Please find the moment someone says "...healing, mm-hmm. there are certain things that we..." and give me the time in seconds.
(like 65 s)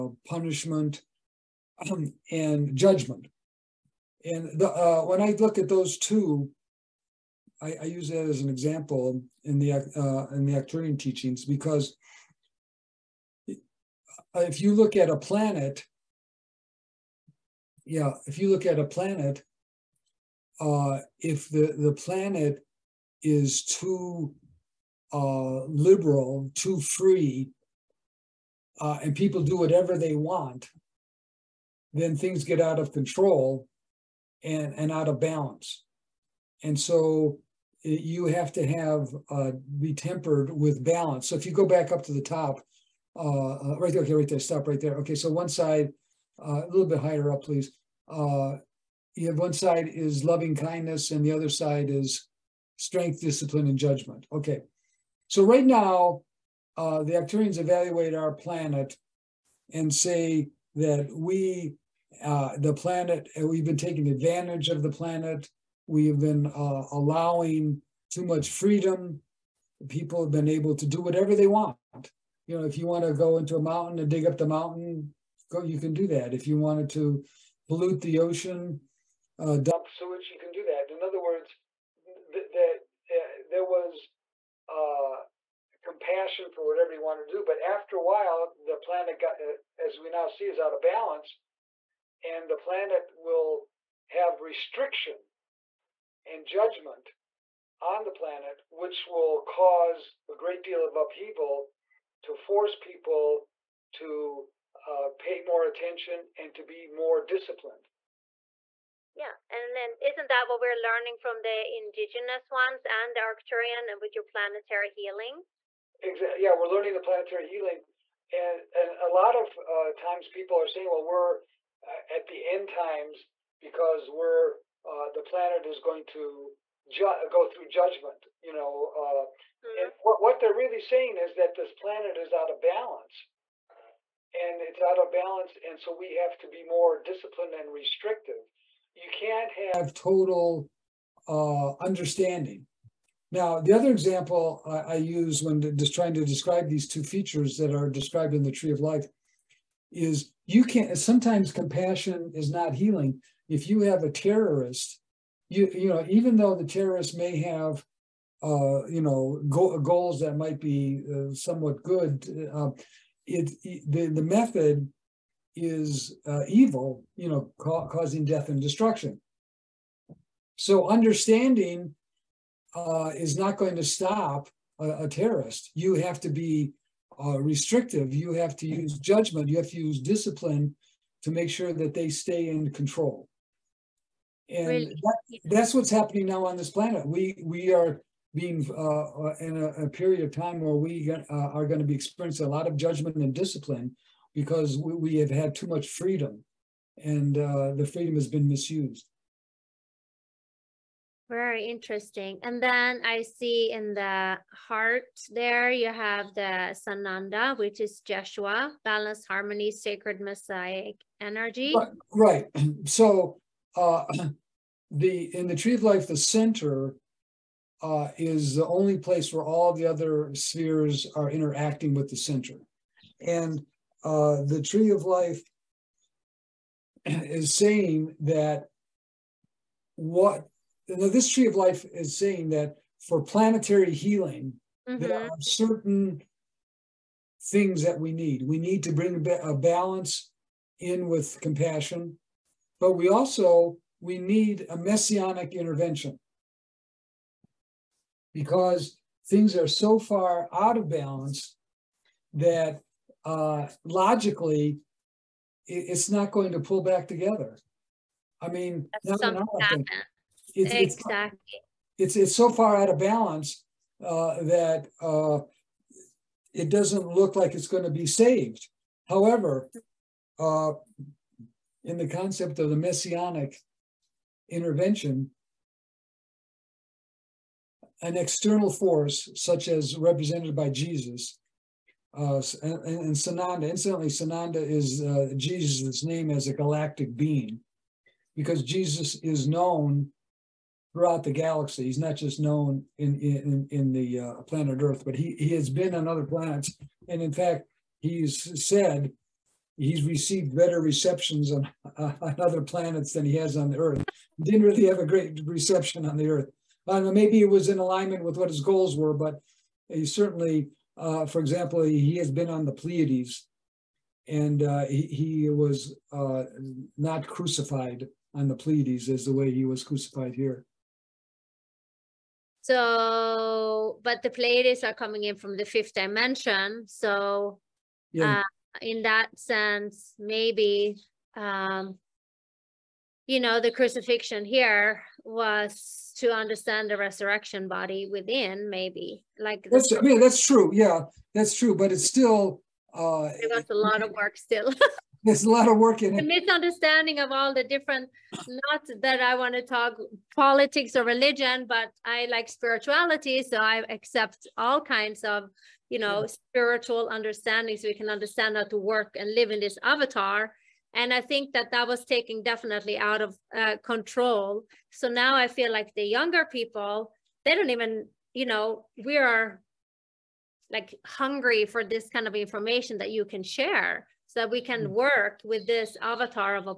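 233 s.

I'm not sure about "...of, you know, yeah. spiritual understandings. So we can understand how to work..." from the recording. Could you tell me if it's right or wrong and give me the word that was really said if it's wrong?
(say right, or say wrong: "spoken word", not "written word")
right.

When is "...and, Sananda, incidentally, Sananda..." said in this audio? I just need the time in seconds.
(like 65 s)
282 s.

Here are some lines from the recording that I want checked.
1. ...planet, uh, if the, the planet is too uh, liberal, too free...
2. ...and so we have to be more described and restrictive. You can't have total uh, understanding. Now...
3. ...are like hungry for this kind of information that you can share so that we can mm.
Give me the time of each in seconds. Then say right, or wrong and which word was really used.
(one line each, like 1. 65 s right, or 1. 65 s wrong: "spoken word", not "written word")
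1. 18 s right
2. 135 s wrong: "disciplined", not "described"
3. 369 s right.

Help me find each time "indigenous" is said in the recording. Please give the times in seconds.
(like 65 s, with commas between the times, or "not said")
111 s.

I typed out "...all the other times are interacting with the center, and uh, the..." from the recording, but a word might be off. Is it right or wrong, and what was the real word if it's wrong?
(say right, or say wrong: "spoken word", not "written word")
wrong: "spheres", not "times".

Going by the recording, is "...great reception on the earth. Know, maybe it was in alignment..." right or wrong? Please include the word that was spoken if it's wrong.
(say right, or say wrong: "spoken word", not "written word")
right.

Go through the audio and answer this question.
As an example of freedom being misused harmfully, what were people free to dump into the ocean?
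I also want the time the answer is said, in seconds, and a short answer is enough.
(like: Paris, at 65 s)
sewage, at 79 s.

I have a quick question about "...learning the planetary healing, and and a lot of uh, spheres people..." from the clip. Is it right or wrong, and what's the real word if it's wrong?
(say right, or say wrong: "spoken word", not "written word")
wrong: "times", not "spheres".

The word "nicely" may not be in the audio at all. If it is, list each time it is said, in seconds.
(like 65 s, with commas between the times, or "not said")
not said.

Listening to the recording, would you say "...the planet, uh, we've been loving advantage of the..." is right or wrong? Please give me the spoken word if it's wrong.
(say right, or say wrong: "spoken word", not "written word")
wrong: "taking", not "loving".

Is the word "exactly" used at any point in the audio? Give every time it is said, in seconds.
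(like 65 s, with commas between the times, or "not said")
116 s, 260 s.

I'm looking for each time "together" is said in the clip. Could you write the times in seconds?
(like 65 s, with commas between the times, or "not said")
257 s.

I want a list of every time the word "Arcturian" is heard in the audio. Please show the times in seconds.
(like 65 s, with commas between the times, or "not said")
10 s, 57 s, 113 s.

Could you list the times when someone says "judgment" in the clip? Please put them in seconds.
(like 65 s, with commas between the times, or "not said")
2 s, 53 s, 96 s, 127 s, 179 s, 192 s.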